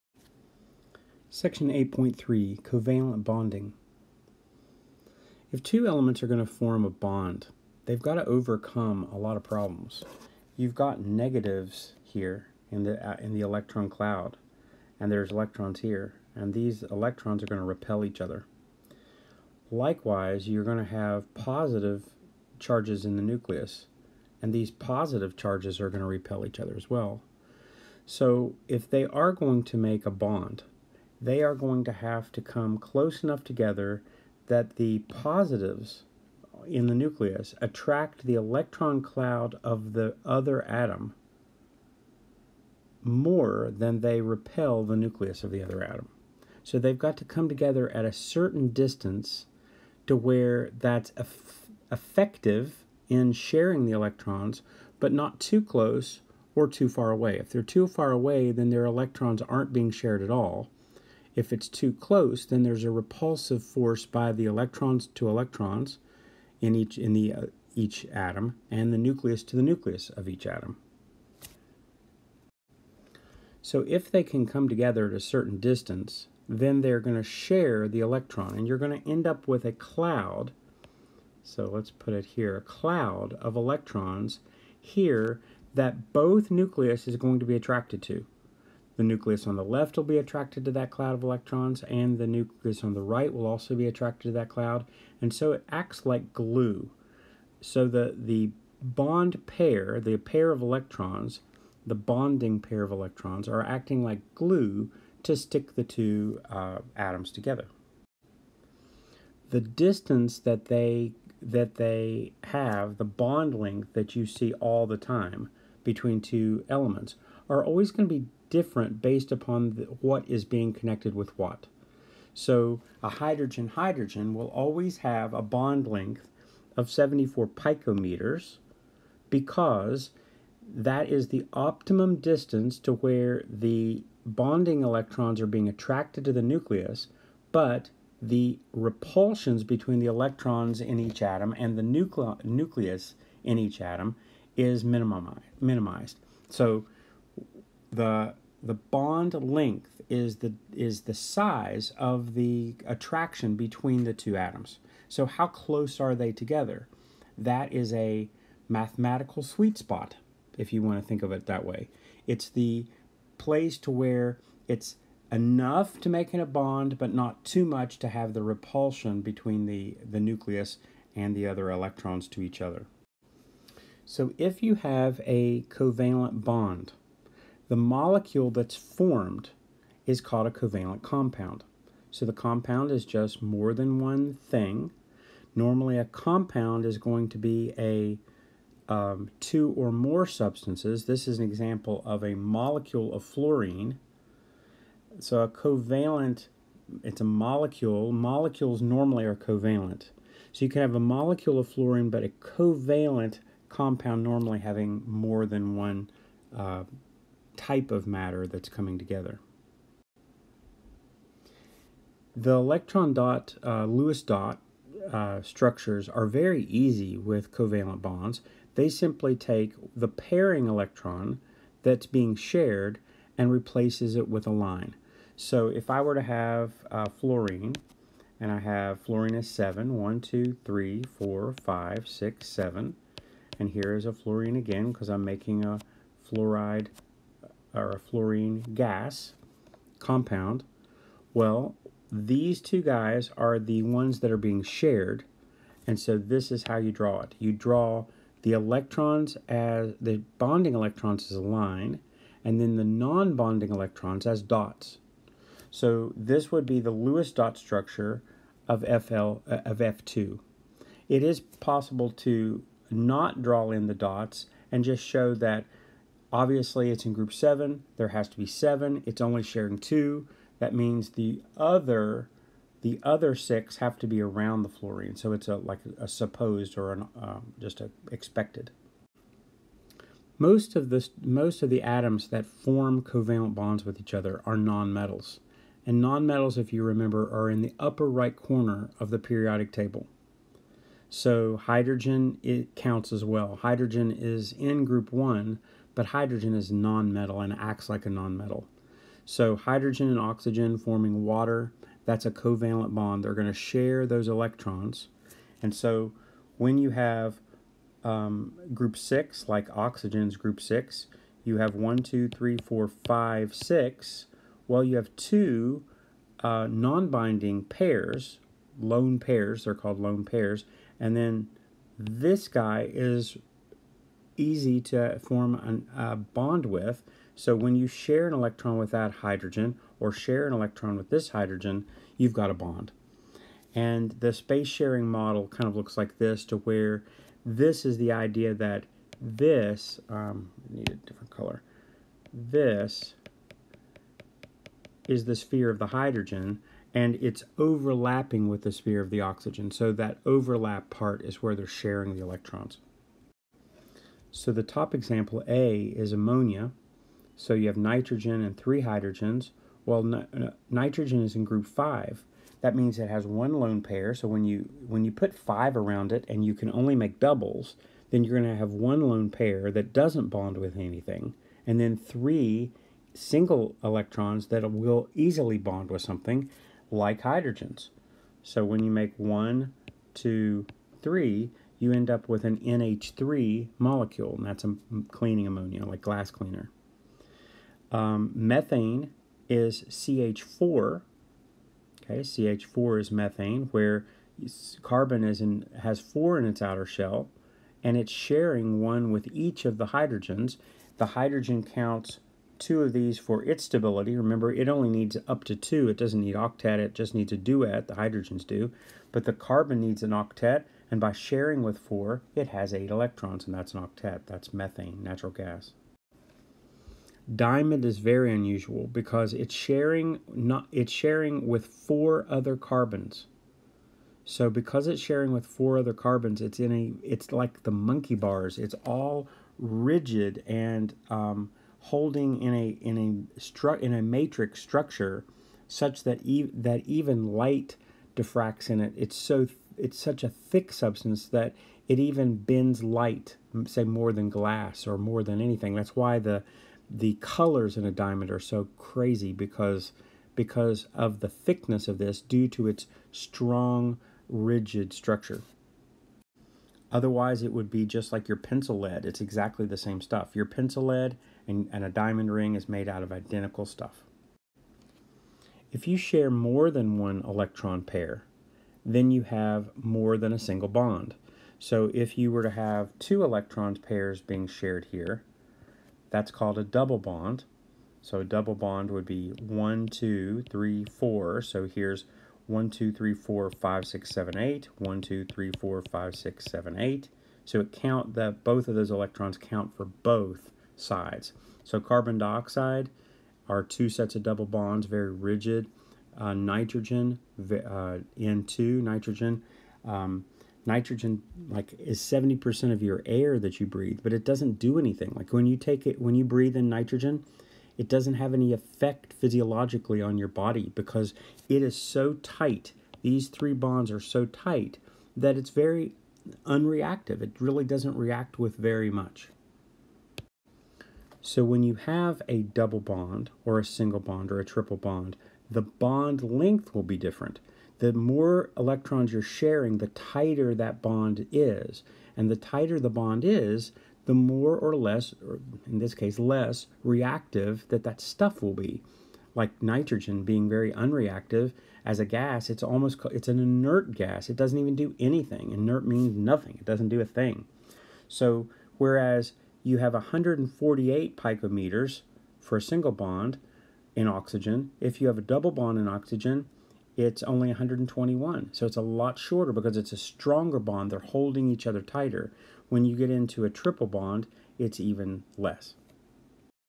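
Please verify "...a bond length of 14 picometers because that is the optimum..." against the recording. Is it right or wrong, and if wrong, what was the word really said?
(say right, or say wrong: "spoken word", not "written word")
wrong: "74", not "14".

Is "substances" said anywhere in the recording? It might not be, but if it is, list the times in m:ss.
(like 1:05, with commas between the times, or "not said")
3:10, 7:20.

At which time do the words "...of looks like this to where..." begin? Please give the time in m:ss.
5:35.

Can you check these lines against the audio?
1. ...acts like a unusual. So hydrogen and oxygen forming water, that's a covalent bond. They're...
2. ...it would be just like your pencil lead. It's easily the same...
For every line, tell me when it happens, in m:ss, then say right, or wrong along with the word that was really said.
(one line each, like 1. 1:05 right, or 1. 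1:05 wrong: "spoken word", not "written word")
1. 4:57 wrong: "nonmetal", not "unusual"
2. 7:37 wrong: "exactly", not "easily".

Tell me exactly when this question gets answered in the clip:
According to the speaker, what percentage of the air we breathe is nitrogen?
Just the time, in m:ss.
8:21.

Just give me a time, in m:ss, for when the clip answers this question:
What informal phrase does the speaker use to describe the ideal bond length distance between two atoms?
2:38.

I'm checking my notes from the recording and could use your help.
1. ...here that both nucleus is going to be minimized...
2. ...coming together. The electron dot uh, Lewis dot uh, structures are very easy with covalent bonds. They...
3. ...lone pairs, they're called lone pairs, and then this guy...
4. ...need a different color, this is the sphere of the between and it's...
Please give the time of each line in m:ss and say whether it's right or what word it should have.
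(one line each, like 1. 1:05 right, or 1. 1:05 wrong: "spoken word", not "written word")
1. 1:24 wrong: "attracted", not "minimized"
2. 3:28 right
3. 5:18 right
4. 5:40 wrong: "hydrogen", not "between".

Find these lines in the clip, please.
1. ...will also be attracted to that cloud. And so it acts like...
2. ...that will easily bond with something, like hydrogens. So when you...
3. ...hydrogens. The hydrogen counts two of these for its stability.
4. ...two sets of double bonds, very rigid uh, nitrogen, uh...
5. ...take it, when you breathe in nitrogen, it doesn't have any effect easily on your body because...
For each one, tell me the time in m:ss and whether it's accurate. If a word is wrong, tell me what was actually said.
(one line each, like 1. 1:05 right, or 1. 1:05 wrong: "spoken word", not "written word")
1. 1:33 right
2. 6:14 right
3. 6:39 right
4. 8:13 right
5. 8:25 wrong: "physiologically", not "easily".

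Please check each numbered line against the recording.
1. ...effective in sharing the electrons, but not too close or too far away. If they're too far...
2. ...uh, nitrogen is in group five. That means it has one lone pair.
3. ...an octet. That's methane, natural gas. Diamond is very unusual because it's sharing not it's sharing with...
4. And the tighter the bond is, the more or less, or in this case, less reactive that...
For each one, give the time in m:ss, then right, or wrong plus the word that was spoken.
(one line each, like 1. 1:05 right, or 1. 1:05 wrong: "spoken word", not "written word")
1. 0:51 right
2. 6:00 right
3. 6:53 right
4. 8:52 right.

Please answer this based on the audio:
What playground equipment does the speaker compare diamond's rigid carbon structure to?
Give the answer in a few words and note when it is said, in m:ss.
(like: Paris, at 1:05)
monkey bars, at 7:07.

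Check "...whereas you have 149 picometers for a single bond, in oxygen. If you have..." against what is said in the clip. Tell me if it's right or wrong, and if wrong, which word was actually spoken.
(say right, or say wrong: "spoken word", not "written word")
wrong: "148", not "149".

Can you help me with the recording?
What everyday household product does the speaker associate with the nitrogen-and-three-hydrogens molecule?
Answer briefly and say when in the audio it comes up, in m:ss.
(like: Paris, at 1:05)
glass cleaner, at 6:25.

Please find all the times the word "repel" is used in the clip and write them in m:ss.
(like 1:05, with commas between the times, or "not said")
0:17, 0:26, 0:44.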